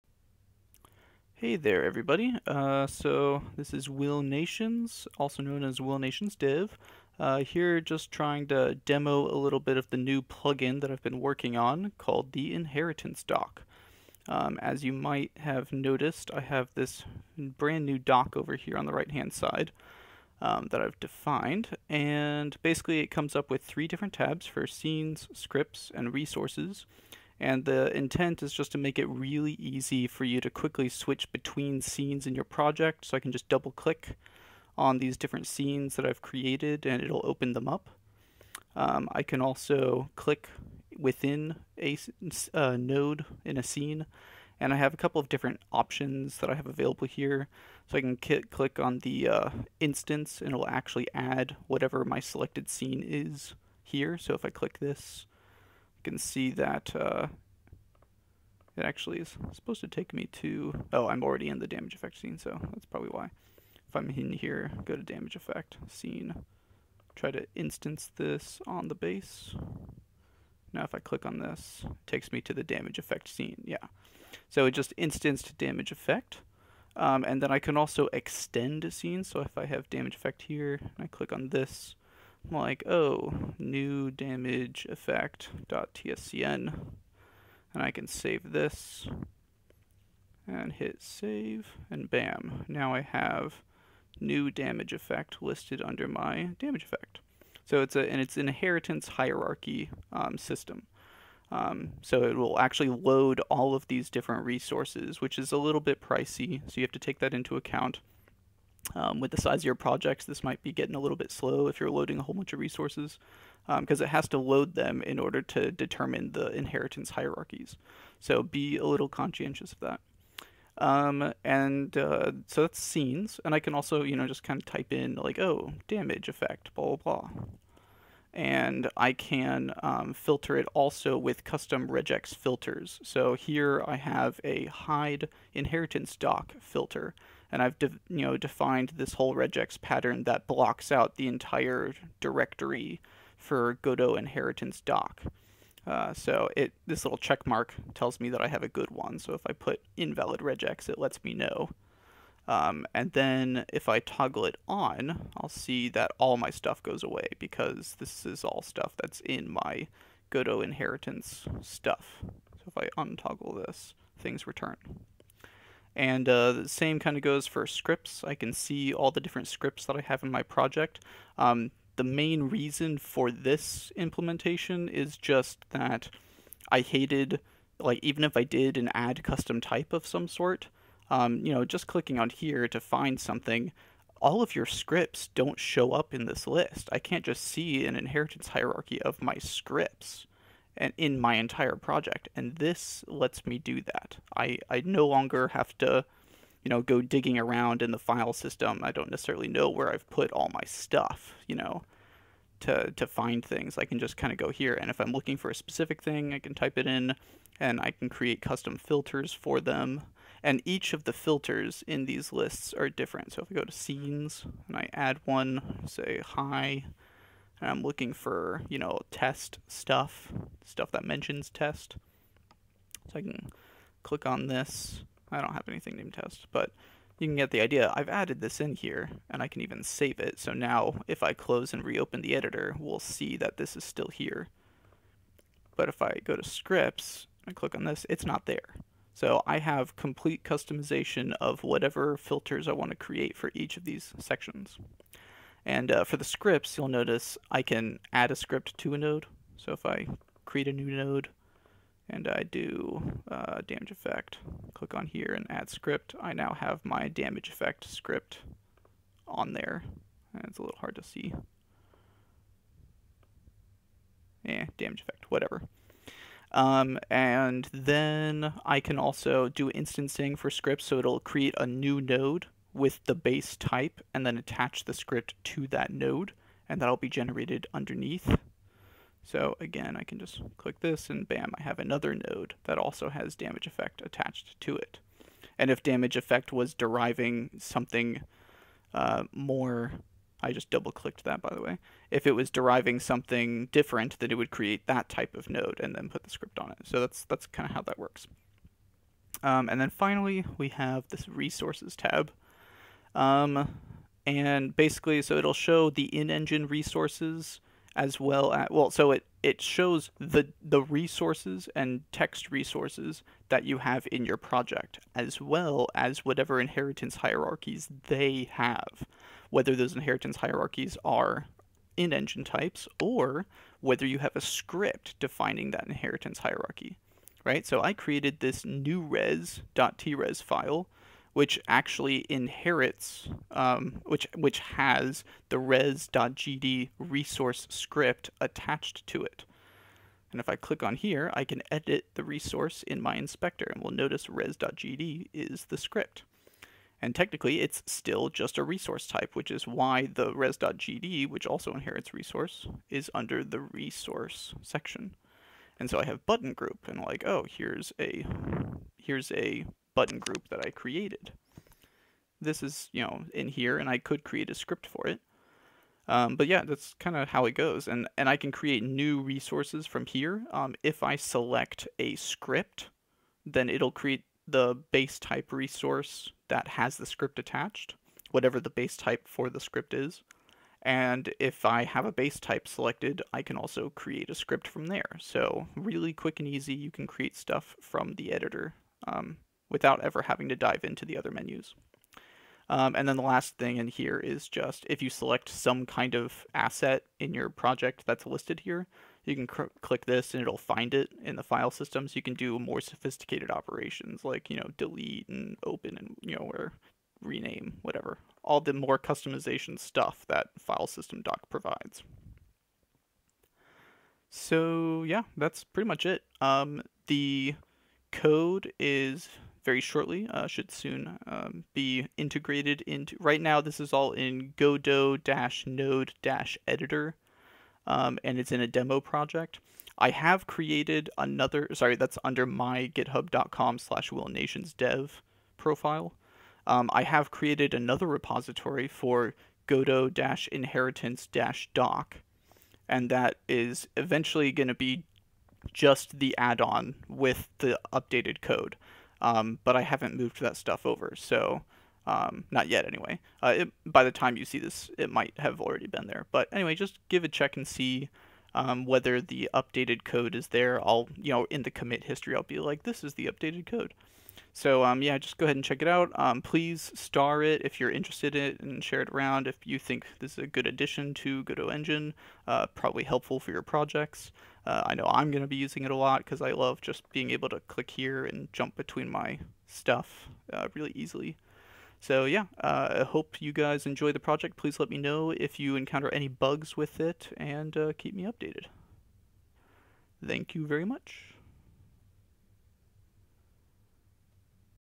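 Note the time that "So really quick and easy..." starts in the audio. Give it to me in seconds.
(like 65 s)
385 s.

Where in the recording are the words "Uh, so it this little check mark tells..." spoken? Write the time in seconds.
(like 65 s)
145 s.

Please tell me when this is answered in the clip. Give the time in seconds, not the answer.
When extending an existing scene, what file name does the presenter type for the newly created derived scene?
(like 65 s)
83 s.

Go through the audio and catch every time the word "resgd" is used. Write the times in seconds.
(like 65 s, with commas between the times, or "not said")
335 s, 344 s, 350 s.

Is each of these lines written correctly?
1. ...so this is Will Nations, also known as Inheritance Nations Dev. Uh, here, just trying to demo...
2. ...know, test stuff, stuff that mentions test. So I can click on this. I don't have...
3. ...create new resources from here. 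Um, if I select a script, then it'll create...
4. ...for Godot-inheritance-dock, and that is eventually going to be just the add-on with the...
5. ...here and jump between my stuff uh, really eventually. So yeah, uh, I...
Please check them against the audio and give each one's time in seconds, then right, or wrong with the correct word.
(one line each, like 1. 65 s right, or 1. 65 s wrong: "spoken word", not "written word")
1. 2 s wrong: "Will", not "Inheritance"
2. 218 s right
3. 368 s right
4. 438 s right
5. 477 s wrong: "easily", not "eventually".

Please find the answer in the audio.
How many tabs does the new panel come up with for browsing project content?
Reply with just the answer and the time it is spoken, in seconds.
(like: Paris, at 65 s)
3, at 23 s.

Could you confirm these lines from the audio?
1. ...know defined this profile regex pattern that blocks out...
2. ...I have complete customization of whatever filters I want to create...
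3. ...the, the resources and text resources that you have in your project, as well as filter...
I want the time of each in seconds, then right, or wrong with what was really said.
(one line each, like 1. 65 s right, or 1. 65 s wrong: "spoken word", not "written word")
1. 138 s wrong: "whole", not "profile"
2. 239 s right
3. 310 s wrong: "whatever", not "filter".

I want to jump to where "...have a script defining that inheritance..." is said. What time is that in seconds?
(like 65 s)
324 s.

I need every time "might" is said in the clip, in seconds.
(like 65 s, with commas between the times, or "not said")
14 s, 110 s, 455 s.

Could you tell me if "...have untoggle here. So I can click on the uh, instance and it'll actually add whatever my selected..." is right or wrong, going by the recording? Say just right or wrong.
wrong.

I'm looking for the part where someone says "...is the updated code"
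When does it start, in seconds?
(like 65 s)
463 s.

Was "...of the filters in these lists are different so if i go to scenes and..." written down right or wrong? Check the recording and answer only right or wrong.
right.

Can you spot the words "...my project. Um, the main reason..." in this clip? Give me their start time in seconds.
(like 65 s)
170 s.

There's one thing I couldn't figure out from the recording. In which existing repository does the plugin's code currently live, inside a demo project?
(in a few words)
Godot-Node-Editor.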